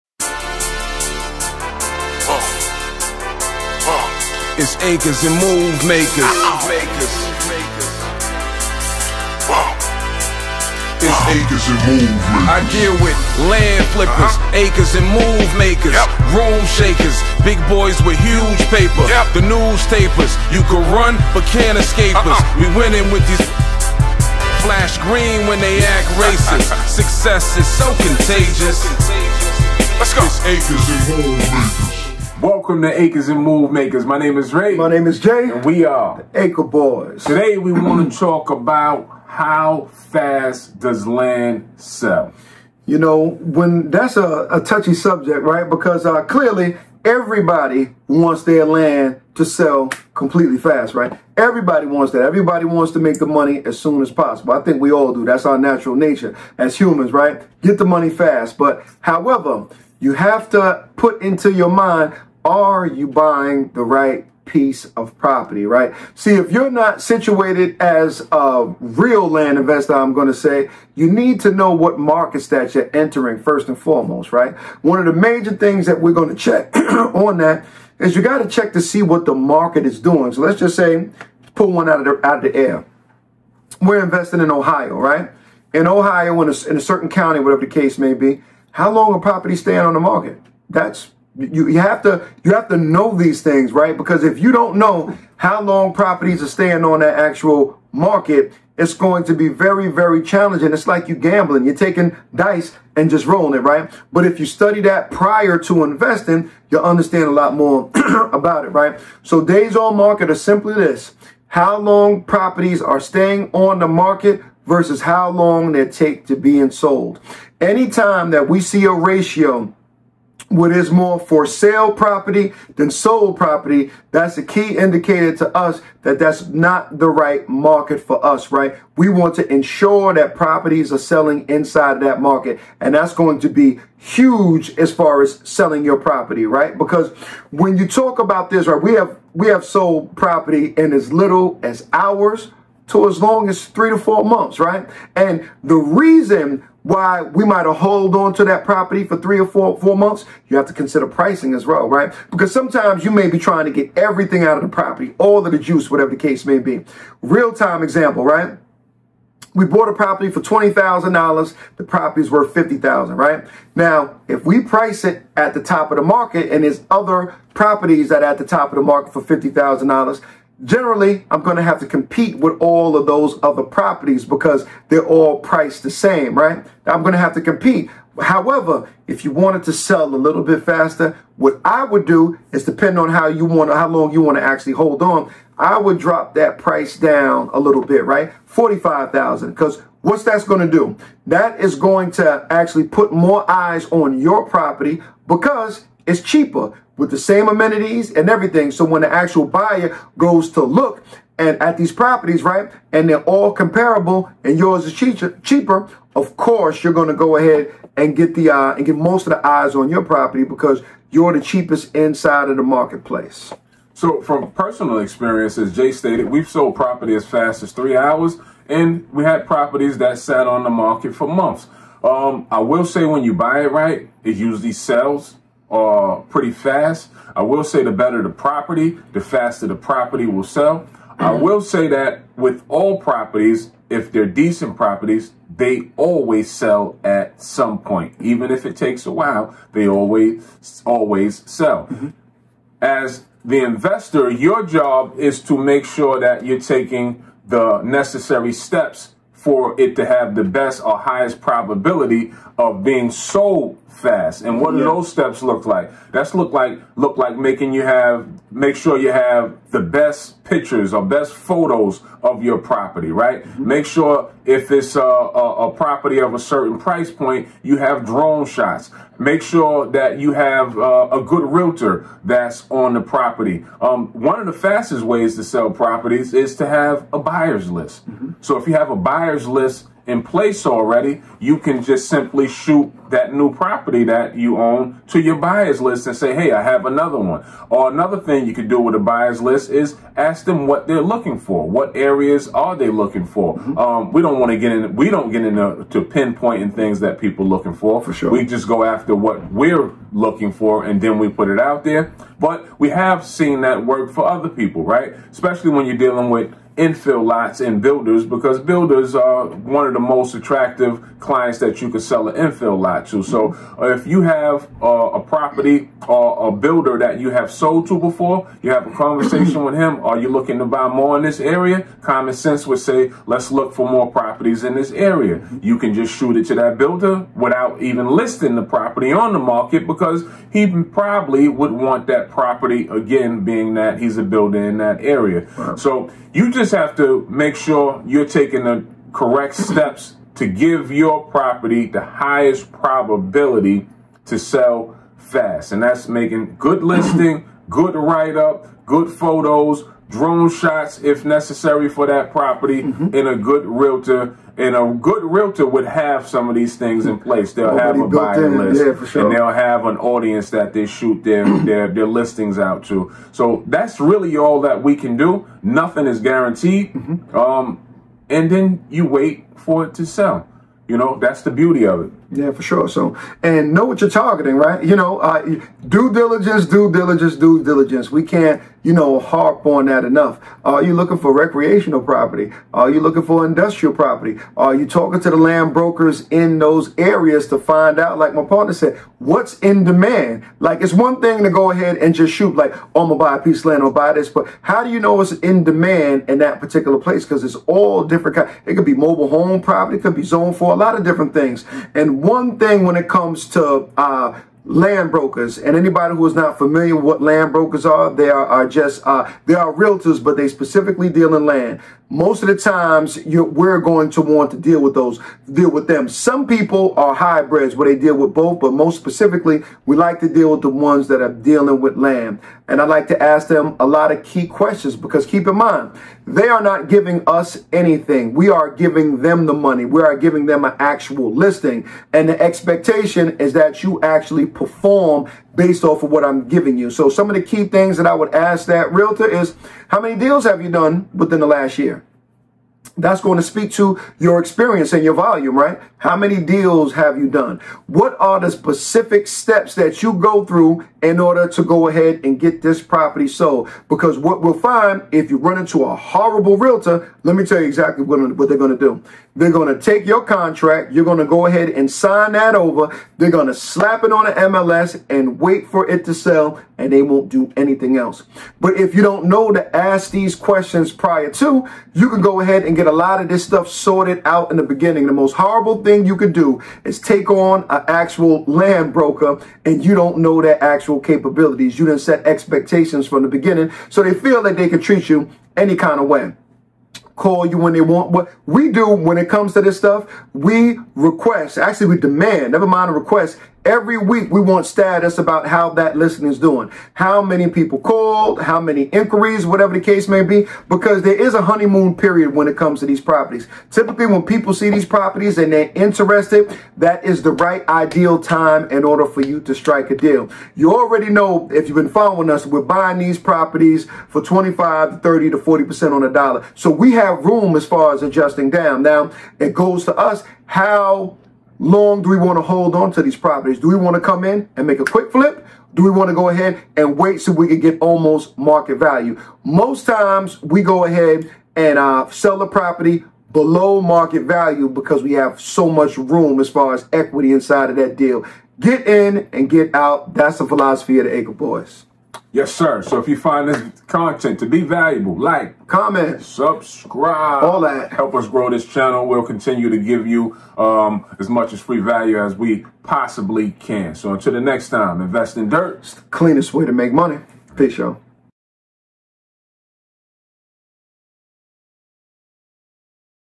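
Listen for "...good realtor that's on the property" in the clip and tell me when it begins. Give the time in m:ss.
4:31.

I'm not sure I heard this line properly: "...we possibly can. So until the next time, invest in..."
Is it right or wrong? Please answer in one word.
right.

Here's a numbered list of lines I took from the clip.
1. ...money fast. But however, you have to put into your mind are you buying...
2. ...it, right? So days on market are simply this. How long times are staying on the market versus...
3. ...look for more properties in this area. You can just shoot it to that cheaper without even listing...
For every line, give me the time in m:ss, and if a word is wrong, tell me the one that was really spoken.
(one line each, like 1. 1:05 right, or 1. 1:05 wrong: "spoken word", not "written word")
1. 0:57 right
2. 1:48 wrong: "properties", not "times"
3. 5:23 wrong: "builder", not "cheaper".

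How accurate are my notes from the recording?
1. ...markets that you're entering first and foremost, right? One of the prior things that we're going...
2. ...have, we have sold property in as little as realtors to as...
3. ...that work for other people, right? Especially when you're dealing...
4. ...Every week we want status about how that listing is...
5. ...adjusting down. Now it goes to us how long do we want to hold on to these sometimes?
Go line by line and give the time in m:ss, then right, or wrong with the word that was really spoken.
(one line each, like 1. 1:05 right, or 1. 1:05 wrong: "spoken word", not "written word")
1. 1:11 wrong: "major", not "prior"
2. 2:18 wrong: "hours", not "realtors"
3. 5:03 right
4. 8:13 right
5. 8:38 wrong: "properties", not "sometimes".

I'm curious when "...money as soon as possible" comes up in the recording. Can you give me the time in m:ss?
0:53.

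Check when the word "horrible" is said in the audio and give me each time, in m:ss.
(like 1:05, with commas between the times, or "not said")
7:35, 7:55.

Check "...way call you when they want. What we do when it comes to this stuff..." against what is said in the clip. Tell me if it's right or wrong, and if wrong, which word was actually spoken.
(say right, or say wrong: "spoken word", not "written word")
right.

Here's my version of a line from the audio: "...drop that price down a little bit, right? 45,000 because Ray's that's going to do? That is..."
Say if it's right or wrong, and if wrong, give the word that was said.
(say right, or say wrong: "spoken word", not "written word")
wrong: "What", not "Ray".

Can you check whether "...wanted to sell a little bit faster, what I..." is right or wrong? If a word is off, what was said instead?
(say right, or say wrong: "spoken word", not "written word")
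right.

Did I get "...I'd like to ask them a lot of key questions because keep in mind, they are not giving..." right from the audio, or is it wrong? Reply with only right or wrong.
right.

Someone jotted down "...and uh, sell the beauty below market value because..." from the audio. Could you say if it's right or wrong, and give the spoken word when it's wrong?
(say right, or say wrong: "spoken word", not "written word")
wrong: "property", not "beauty".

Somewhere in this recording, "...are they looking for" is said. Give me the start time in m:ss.
4:52.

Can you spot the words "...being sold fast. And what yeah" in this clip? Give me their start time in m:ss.
4:12.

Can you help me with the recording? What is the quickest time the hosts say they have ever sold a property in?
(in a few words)
3 hours.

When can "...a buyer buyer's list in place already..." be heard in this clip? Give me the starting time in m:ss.
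4:38.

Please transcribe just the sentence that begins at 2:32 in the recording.
Because sometimes you may be trying to get everything out of the property, all of the juice, whatever the case may be.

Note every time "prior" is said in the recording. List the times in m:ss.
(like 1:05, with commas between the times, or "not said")
1:45, 7:50.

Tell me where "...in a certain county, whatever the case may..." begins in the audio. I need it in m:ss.
1:26.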